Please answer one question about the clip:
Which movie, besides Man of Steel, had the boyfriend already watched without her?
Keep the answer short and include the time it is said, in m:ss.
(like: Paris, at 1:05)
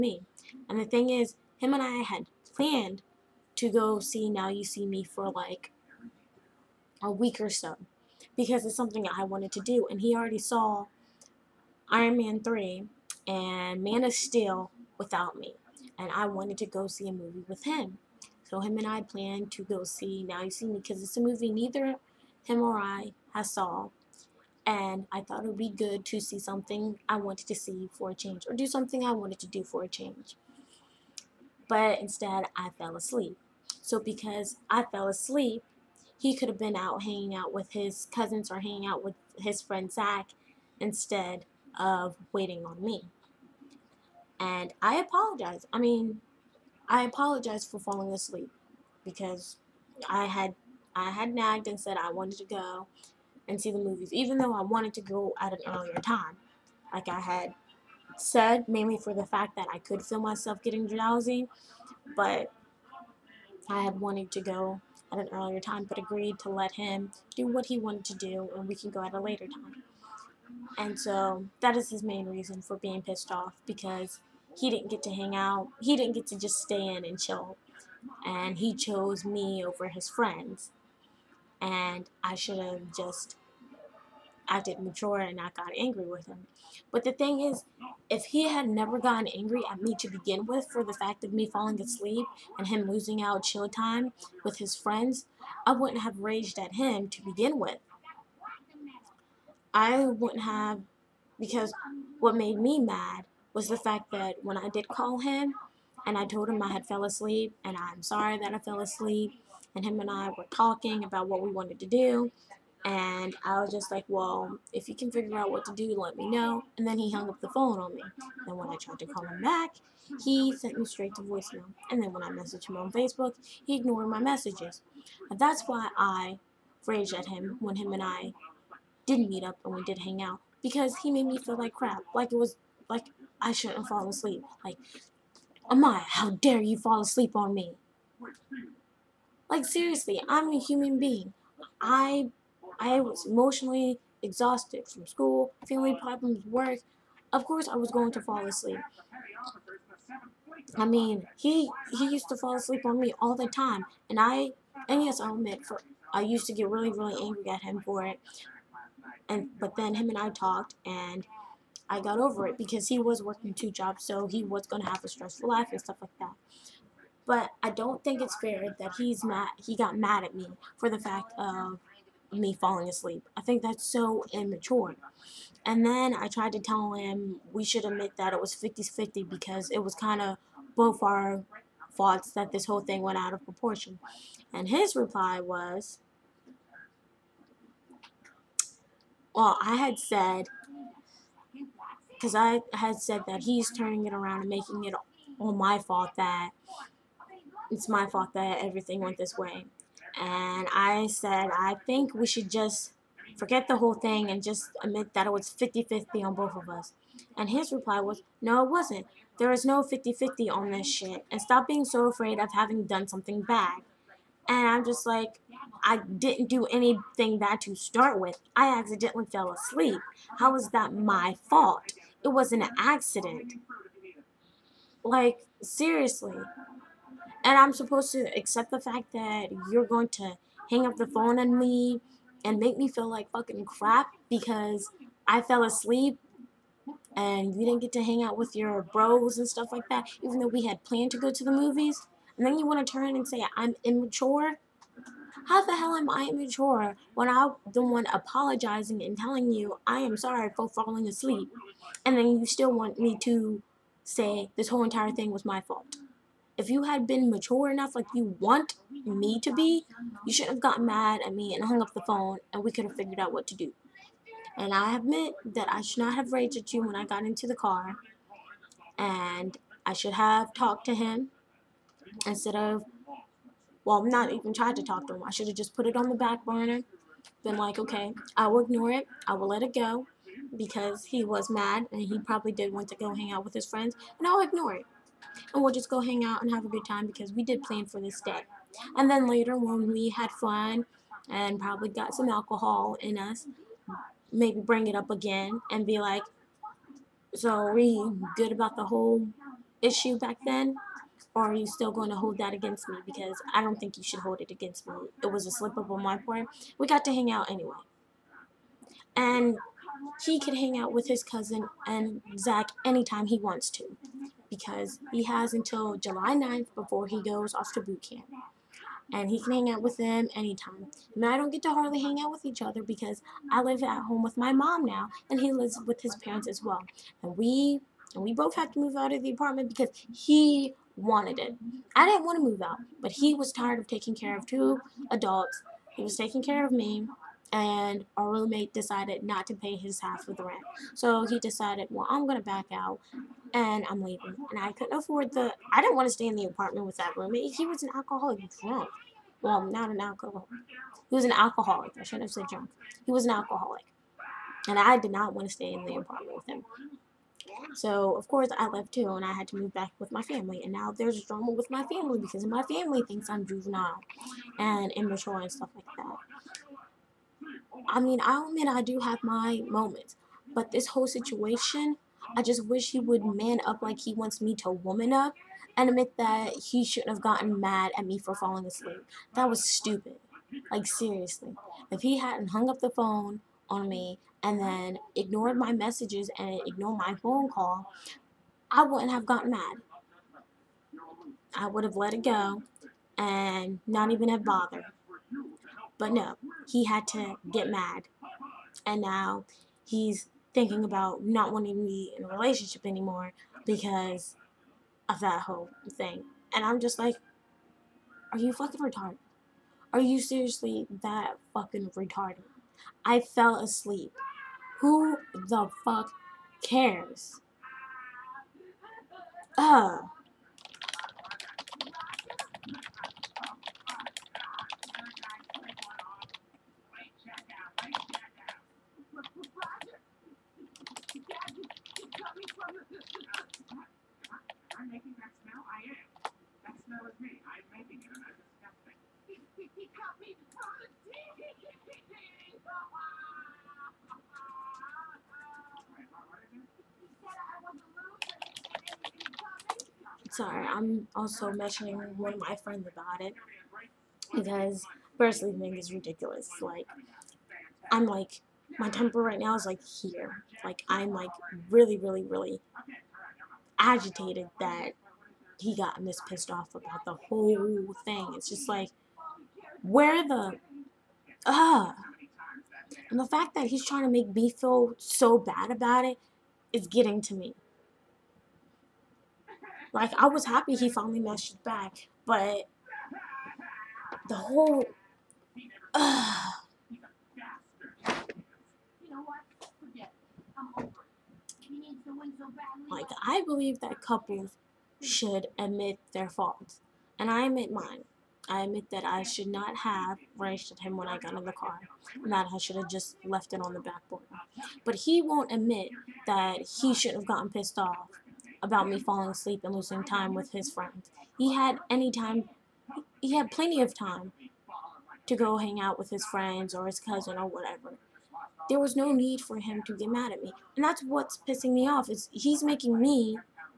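Iron Man 3, at 0:11.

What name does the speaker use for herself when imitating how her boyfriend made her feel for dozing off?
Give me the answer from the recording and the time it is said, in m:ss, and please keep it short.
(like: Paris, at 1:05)
Amaya, at 2:15.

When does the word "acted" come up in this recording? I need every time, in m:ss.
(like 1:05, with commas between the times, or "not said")
1:24.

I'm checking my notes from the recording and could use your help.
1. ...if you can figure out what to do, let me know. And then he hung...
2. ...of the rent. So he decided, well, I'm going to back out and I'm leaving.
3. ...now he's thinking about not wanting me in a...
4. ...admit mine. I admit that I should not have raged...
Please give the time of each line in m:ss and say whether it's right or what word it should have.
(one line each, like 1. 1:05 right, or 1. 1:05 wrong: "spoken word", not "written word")
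1. 1:54 right
2. 5:40 right
3. 6:39 right
4. 8:17 right.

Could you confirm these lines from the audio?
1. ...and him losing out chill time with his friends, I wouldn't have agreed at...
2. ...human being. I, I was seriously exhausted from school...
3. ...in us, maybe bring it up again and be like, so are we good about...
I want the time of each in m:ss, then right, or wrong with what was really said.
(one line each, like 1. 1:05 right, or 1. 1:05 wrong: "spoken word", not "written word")
1. 1:32 wrong: "raged", not "agreed"
2. 2:20 wrong: "emotionally", not "seriously"
3. 4:52 right.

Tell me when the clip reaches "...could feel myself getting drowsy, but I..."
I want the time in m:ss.
0:59.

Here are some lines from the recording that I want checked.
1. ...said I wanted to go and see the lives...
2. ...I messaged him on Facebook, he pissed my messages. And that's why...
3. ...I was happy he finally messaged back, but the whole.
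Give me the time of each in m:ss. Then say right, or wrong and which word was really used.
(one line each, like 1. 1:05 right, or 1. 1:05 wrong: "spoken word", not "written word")
1. 0:51 wrong: "movies", not "lives"
2. 2:02 wrong: "ignored", not "pissed"
3. 8:00 right.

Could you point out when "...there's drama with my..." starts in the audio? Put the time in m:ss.
6:00.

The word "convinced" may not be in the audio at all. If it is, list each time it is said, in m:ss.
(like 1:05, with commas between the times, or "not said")
not said.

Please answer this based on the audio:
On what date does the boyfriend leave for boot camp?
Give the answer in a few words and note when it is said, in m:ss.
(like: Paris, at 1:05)
July 9, at 5:15.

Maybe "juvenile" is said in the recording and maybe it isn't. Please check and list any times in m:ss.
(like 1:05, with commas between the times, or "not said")
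6:03.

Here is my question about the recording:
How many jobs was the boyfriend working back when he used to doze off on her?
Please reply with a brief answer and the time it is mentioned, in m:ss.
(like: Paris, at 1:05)
2, at 2:43.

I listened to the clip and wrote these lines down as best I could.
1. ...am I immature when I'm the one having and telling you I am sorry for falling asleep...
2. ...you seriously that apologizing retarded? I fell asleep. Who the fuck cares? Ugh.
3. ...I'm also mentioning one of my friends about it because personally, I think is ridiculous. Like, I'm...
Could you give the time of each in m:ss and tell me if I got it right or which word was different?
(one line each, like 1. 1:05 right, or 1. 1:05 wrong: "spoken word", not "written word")
1. 4:05 wrong: "apologizing", not "having"
2. 6:49 wrong: "fucking", not "apologizing"
3. 7:30 right.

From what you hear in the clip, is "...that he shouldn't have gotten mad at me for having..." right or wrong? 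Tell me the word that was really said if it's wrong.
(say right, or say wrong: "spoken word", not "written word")
wrong: "falling", not "having".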